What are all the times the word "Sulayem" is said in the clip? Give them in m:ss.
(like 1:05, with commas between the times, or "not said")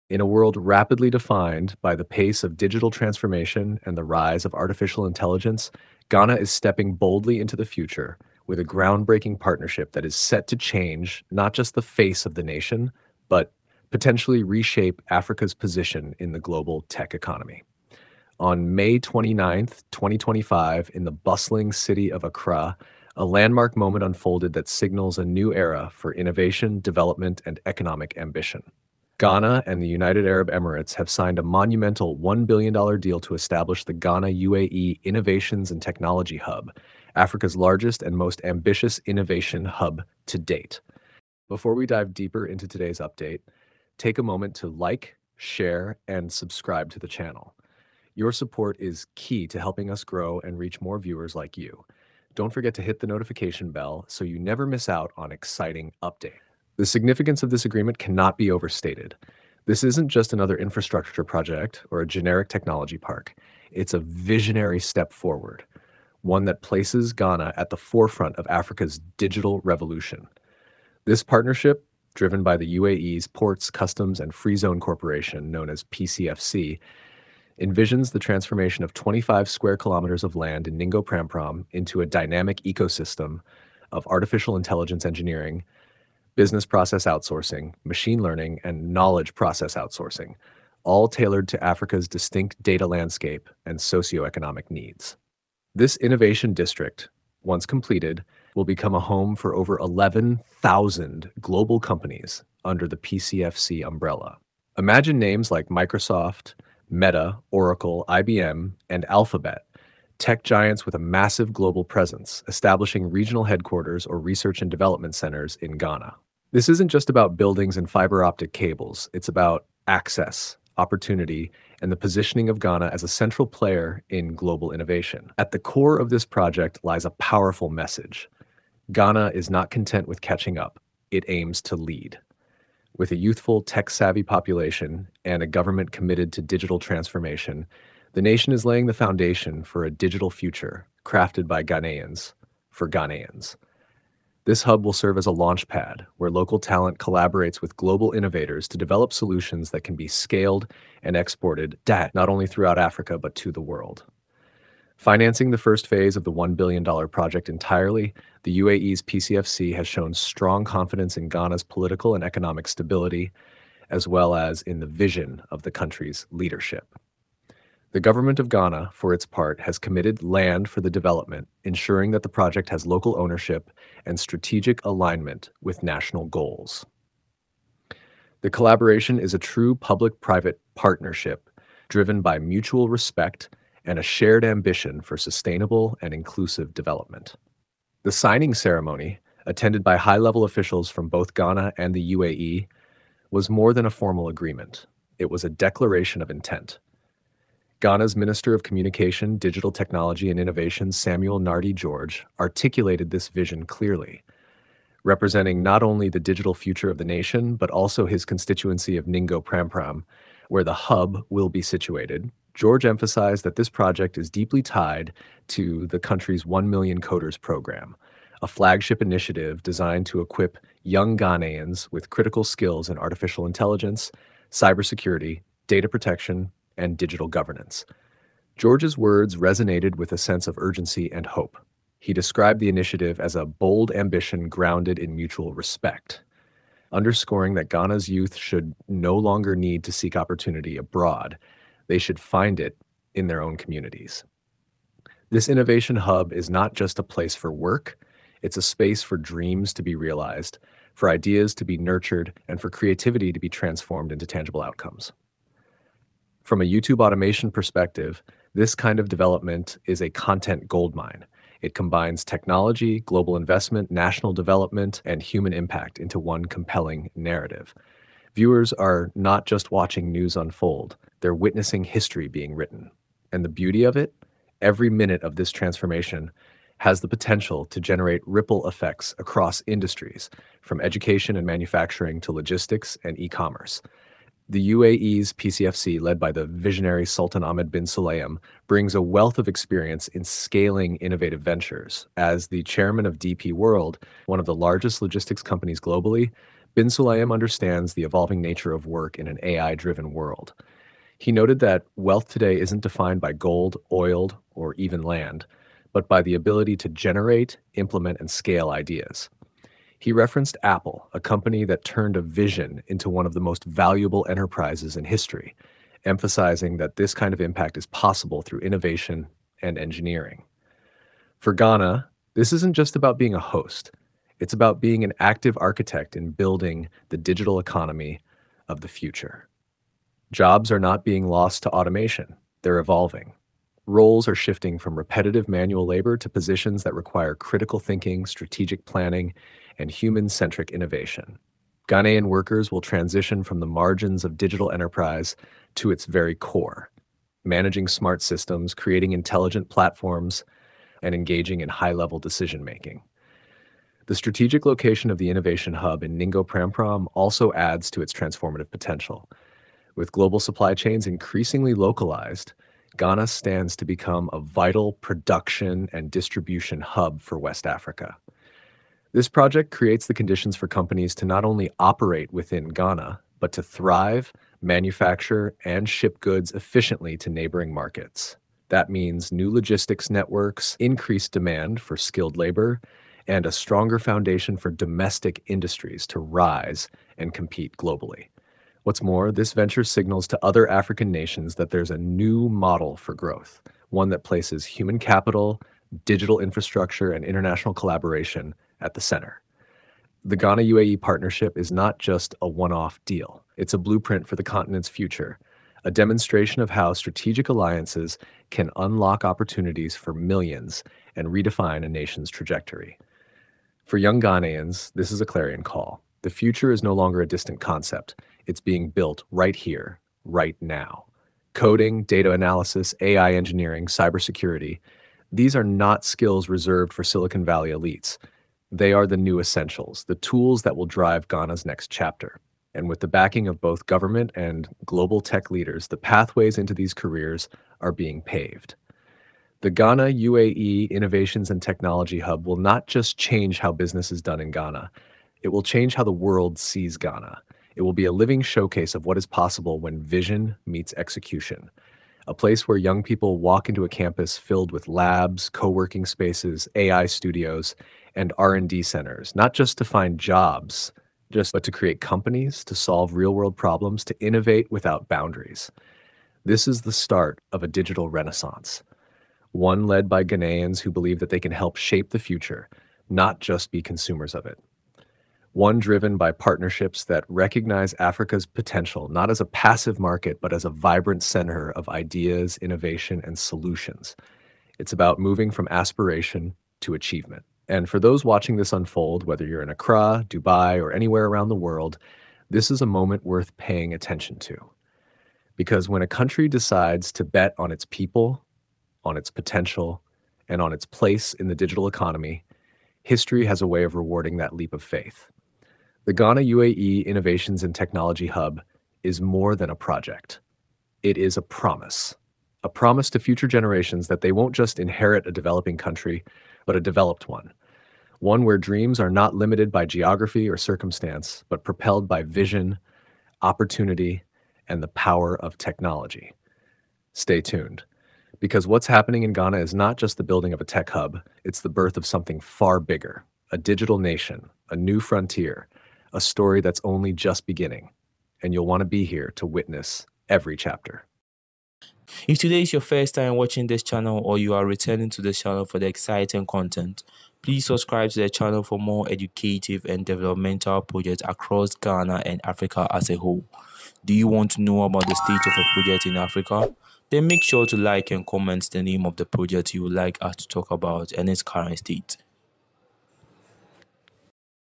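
4:47, 4:56.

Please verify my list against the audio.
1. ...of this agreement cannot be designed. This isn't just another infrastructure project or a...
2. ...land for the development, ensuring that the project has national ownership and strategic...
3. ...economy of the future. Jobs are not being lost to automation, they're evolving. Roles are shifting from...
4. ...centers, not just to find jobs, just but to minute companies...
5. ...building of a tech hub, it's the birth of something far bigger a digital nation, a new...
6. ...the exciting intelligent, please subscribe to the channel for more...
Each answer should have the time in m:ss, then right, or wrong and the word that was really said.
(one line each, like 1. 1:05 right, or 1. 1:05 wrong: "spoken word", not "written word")
1. 0:57 wrong: "overstated", not "designed"
2. 2:50 wrong: "local", not "national"
3. 5:27 right
4. 7:38 wrong: "create", not "minute"
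5. 8:50 right
6. 9:05 wrong: "content", not "intelligent".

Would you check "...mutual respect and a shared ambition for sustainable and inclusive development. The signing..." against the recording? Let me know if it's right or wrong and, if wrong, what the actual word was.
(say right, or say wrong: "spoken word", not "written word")
right.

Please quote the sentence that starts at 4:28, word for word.
Viewers are not just watching news unfold, they're witnessing history being written.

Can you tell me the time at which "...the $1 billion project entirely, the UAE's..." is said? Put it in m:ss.
2:36.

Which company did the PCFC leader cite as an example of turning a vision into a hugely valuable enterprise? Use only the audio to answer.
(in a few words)
Apple.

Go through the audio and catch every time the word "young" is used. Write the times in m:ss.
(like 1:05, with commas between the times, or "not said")
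3:40, 6:53, 7:32.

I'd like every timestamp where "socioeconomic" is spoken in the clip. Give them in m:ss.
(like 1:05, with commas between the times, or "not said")
1:33.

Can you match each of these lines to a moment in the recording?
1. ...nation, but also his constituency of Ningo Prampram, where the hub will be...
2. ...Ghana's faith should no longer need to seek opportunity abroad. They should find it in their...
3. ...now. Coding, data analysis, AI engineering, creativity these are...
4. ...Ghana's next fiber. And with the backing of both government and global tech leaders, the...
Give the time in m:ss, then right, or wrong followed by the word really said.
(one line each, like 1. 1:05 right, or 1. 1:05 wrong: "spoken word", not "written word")
1. 3:27 right
2. 3:57 wrong: "youth", not "faith"
3. 7:00 wrong: "cybersecurity", not "creativity"
4. 7:11 wrong: "chapter", not "fiber".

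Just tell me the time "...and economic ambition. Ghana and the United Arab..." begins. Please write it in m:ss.
0:27.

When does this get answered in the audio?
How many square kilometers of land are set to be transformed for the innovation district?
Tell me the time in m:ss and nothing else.
1:18.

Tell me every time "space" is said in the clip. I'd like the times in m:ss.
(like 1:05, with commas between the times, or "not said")
4:08, 7:36.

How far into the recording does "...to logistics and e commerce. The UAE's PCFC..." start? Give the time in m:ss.
4:42.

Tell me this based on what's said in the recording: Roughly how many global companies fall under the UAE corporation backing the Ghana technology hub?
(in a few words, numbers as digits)
11,000.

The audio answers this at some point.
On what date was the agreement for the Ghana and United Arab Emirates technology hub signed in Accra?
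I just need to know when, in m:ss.
0:18.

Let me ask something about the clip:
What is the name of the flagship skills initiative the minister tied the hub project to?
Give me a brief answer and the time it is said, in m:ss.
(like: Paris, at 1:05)
1 million coders program, at 3:36.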